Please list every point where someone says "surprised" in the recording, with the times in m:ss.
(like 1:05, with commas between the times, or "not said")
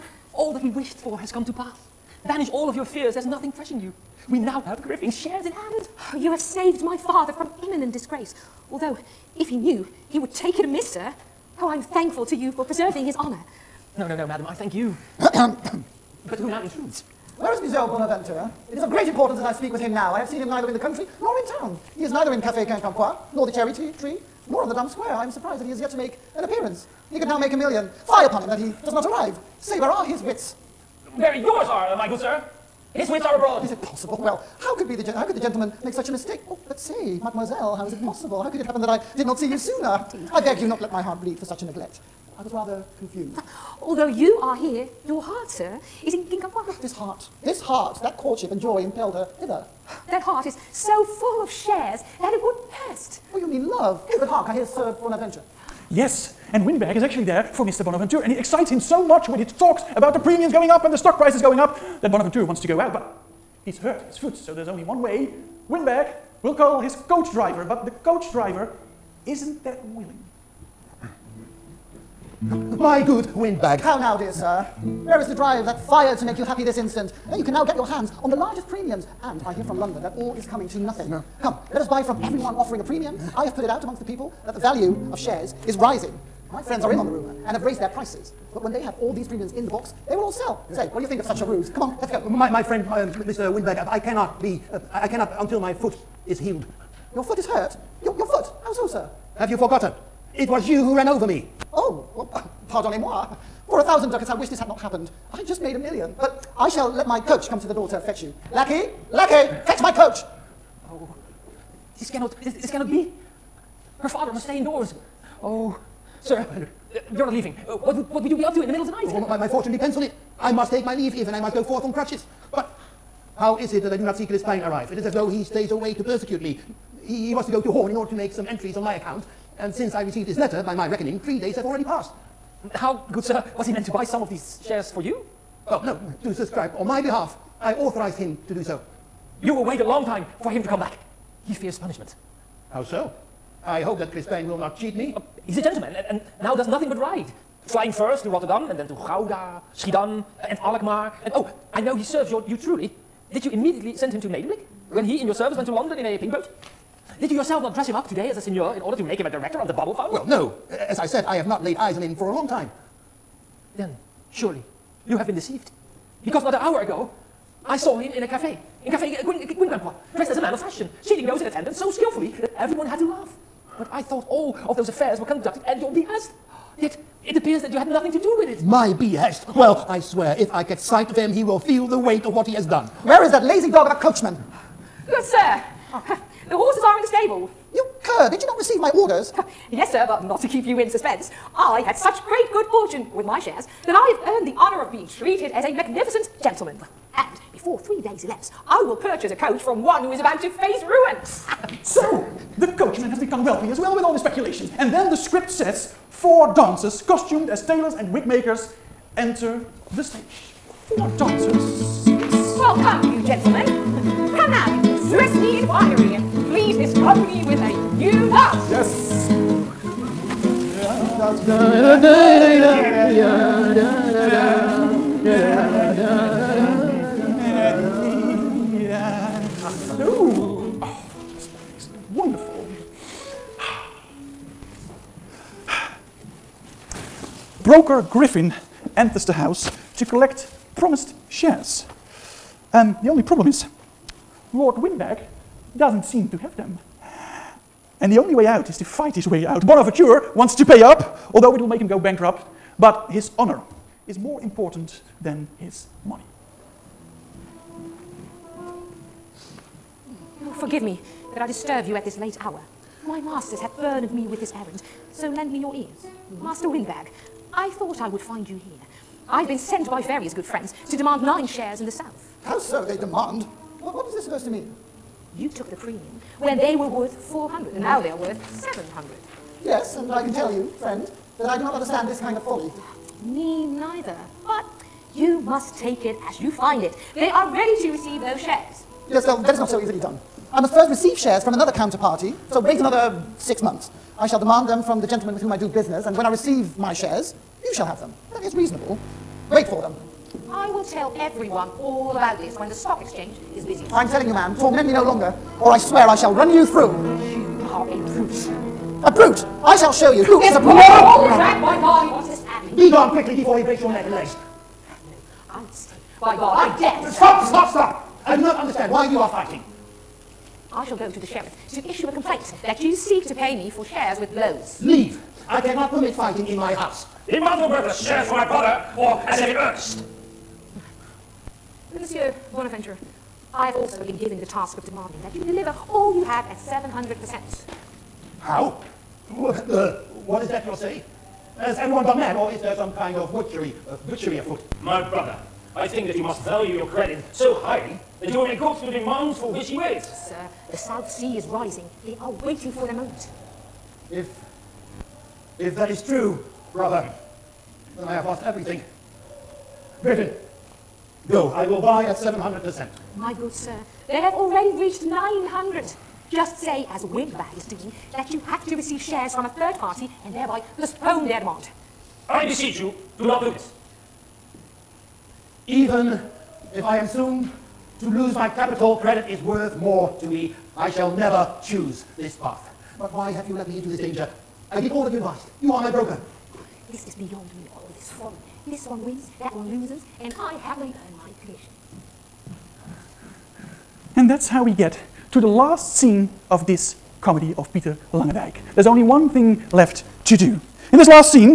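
0:25.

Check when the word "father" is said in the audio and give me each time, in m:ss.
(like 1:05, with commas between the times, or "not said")
0:06, 1:54.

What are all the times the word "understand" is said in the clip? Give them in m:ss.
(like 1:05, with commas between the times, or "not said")
4:41, 5:18.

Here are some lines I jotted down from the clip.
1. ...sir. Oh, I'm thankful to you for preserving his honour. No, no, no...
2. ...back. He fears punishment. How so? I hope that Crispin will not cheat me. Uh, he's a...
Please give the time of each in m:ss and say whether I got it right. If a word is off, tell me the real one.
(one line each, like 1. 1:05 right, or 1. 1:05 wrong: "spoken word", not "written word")
1. 0:10 right
2. 2:20 right.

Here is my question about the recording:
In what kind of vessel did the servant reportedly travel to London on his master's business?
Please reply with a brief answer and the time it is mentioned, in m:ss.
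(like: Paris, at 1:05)
A pink boat, at 2:36.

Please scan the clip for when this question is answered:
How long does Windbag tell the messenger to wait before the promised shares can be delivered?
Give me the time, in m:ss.
4:53.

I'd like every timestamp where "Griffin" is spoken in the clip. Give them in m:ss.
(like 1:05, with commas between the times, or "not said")
0:04, 3:58.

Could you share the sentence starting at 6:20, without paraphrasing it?
I shall never choose this path.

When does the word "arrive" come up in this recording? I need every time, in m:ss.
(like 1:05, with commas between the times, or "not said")
0:29, 2:04.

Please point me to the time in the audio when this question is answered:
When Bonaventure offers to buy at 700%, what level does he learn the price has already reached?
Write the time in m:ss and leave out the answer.
6:05.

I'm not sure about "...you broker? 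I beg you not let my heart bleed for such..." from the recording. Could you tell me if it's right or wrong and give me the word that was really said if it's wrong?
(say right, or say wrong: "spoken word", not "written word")
wrong: "sooner", not "broker".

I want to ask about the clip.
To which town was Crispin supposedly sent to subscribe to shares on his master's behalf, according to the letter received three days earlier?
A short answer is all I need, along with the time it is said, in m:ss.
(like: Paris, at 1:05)
Hoorn, at 2:07.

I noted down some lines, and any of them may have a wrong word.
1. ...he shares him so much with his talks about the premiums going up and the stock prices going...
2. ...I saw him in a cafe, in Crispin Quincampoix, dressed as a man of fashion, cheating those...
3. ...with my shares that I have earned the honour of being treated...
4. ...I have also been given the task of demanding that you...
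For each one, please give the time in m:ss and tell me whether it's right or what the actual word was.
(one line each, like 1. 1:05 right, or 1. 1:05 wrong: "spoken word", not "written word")
1. 0:58 wrong: "excites", not "shares"
2. 2:47 wrong: "Café", not "Crispin"
3. 3:13 right
4. 5:33 right.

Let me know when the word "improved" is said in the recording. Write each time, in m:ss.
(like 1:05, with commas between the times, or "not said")
not said.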